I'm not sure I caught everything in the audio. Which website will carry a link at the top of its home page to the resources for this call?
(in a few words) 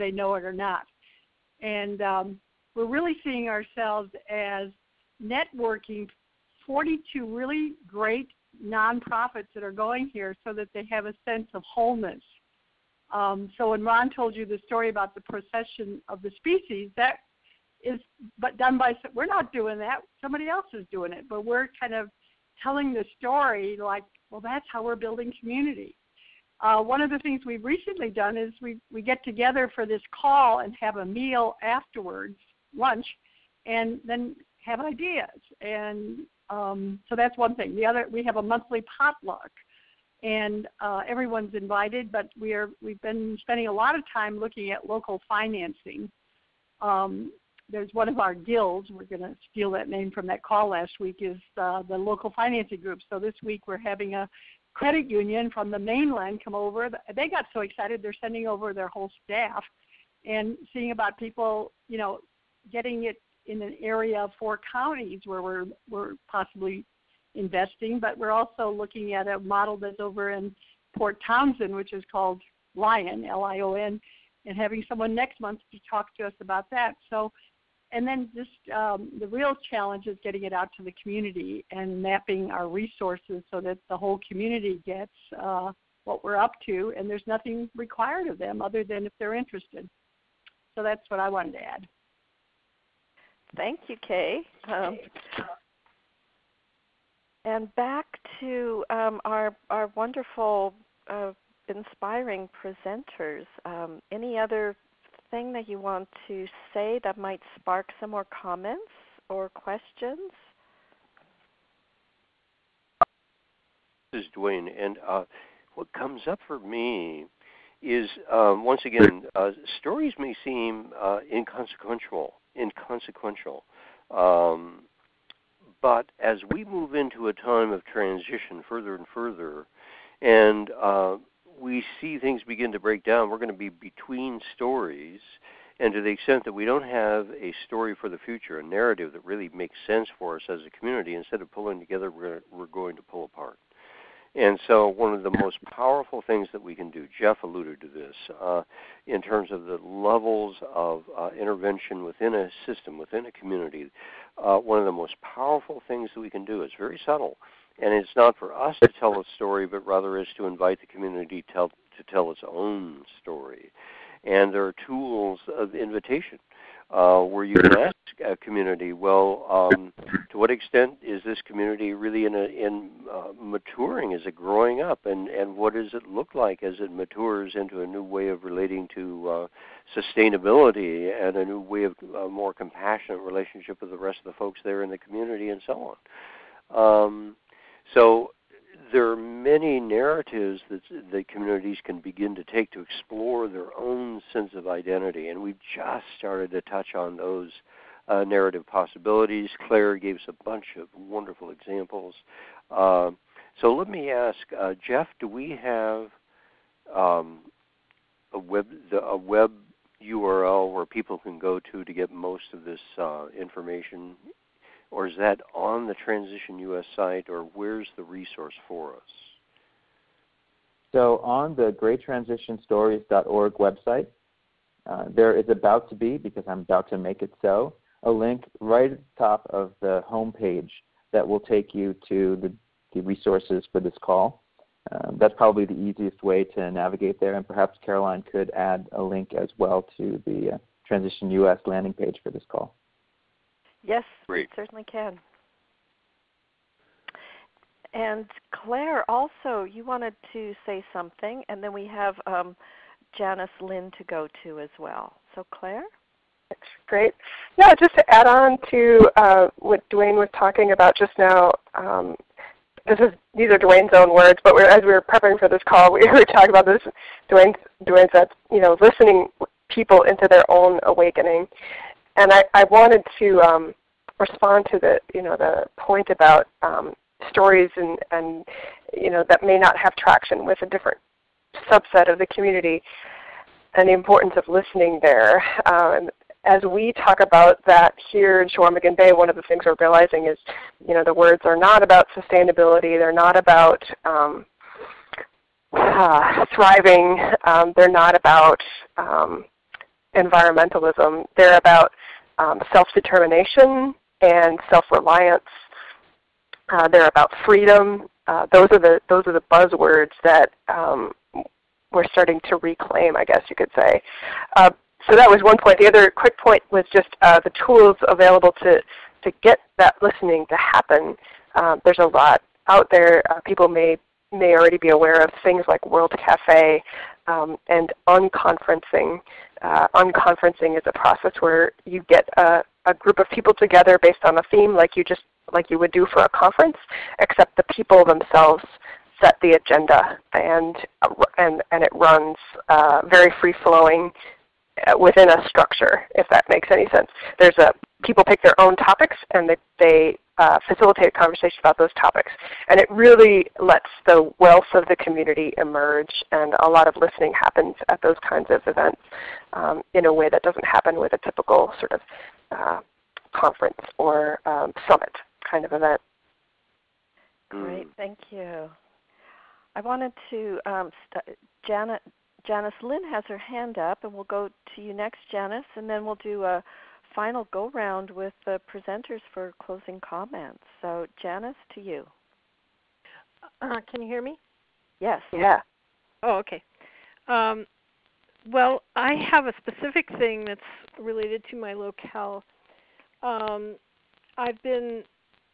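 greattransitionstories.org.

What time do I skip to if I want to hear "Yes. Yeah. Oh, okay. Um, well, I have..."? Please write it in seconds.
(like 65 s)
385 s.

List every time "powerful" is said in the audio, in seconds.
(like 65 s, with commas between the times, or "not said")
145 s, 155 s.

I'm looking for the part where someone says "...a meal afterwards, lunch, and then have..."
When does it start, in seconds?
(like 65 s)
30 s.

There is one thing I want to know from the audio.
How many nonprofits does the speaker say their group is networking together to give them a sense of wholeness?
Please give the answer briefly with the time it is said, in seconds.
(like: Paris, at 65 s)
42, at 6 s.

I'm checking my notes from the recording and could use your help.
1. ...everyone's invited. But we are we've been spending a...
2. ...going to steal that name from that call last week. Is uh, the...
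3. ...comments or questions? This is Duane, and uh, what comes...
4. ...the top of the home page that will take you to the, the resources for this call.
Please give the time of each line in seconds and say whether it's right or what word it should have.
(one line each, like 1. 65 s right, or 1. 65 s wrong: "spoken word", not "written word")
1. 41 s right
2. 49 s right
3. 108 s right
4. 228 s right.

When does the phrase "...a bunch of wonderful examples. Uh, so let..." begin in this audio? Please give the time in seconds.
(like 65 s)
200 s.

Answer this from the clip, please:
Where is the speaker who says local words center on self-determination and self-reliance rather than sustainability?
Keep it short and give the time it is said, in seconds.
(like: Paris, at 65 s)
Chequamegon Bay, at 288 s.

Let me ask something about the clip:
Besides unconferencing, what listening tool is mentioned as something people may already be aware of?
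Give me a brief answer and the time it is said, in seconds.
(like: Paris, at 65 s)
World Cafe, at 325 s.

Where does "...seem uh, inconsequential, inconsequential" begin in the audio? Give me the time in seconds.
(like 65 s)
120 s.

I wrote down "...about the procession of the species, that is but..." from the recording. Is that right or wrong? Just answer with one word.
right.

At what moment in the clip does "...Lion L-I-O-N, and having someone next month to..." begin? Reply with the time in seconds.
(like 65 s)
72 s.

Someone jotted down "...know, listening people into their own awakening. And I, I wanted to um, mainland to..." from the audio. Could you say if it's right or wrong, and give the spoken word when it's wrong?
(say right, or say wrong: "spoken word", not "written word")
wrong: "respond", not "mainland".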